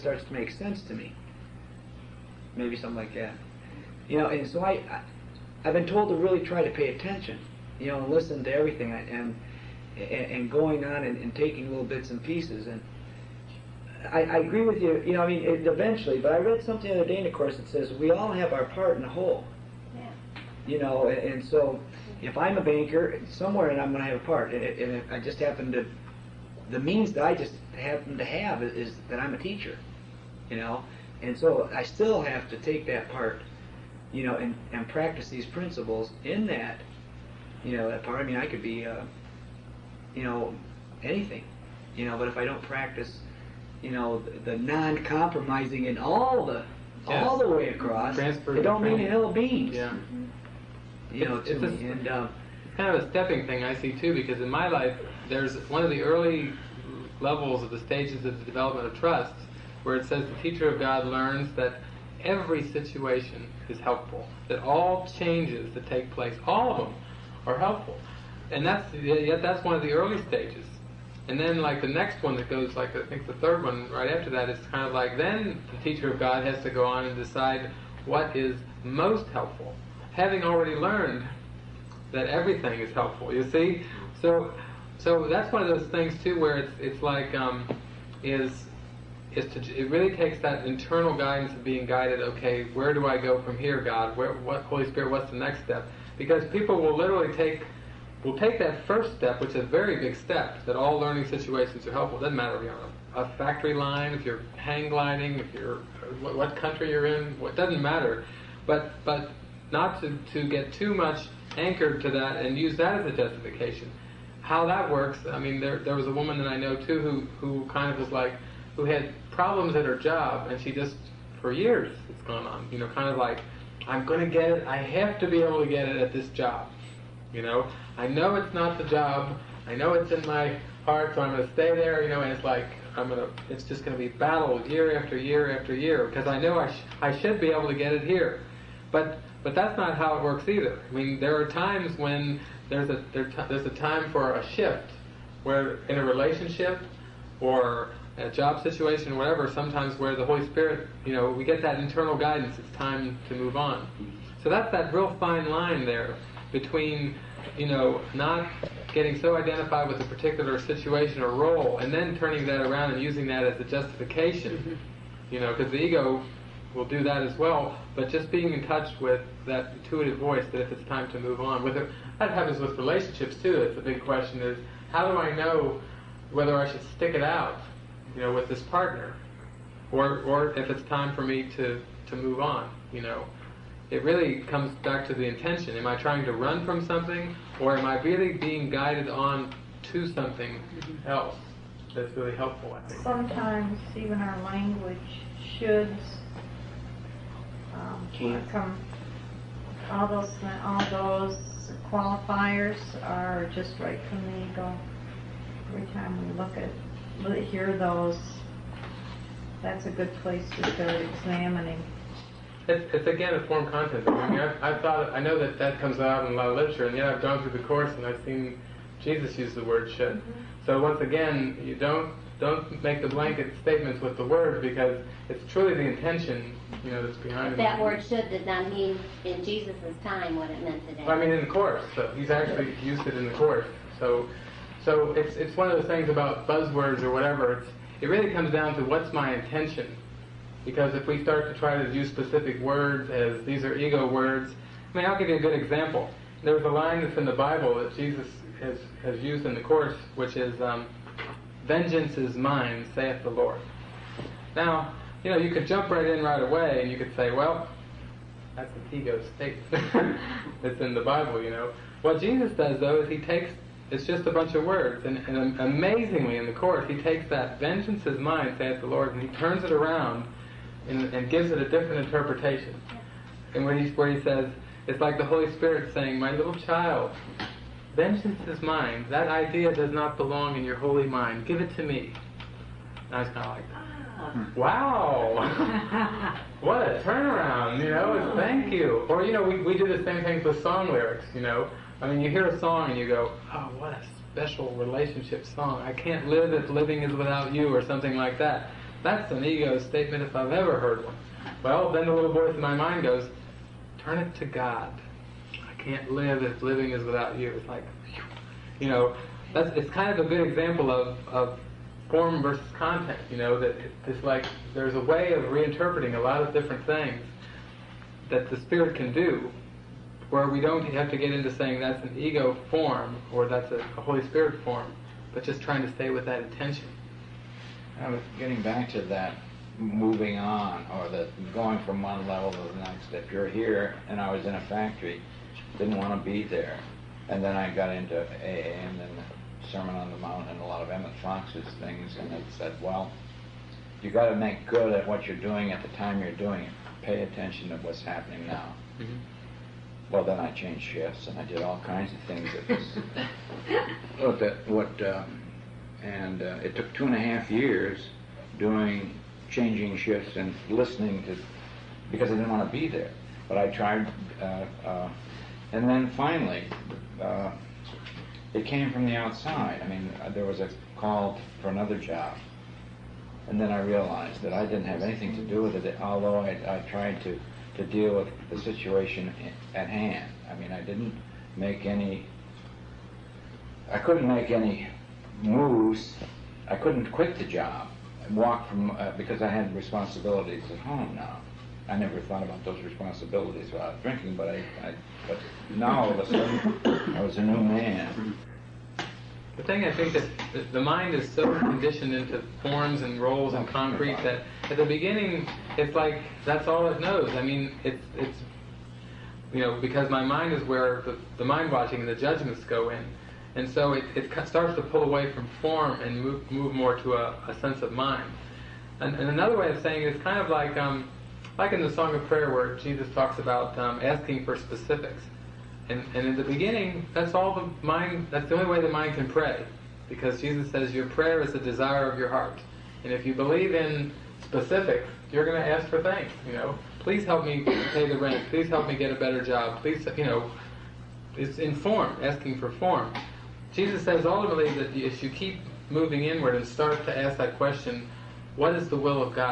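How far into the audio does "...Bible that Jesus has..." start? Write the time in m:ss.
4:07.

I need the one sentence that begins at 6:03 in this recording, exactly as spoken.
But I tried uh, uh, and then finally, uh, it came from the outside.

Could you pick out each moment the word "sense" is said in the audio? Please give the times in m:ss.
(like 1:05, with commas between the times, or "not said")
0:00, 6:57.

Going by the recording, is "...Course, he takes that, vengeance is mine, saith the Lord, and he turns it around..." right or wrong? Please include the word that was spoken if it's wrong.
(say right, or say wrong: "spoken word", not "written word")
right.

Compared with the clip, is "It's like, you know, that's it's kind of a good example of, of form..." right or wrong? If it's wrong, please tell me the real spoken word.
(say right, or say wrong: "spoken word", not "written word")
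right.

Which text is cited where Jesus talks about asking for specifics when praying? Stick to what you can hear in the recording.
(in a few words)
Song of Prayer.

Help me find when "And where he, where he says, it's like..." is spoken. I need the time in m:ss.
4:33.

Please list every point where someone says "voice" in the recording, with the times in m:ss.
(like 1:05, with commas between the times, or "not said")
2:50, 5:02.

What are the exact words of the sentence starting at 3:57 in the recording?
It's, it really comes down to what's my intention.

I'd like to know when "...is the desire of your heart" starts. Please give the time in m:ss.
7:11.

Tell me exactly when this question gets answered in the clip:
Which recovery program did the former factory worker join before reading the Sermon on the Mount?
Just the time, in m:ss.
5:38.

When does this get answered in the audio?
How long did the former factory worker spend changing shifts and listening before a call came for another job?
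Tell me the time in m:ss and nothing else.
5:56.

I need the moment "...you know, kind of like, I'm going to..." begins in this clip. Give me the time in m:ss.
2:02.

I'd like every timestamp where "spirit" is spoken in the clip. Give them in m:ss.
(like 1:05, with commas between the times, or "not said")
1:34, 2:30, 4:35, 5:18, 5:24.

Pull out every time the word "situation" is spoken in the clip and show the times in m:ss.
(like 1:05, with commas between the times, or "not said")
1:02, 1:41, 2:28, 2:40, 6:18.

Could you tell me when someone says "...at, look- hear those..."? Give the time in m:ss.
3:26.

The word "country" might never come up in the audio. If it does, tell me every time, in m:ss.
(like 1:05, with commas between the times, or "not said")
1:46.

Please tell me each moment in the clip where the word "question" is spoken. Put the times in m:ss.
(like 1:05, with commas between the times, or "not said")
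2:54, 7:27.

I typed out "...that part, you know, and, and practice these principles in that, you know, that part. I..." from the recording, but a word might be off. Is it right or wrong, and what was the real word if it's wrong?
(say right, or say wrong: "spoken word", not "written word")
right.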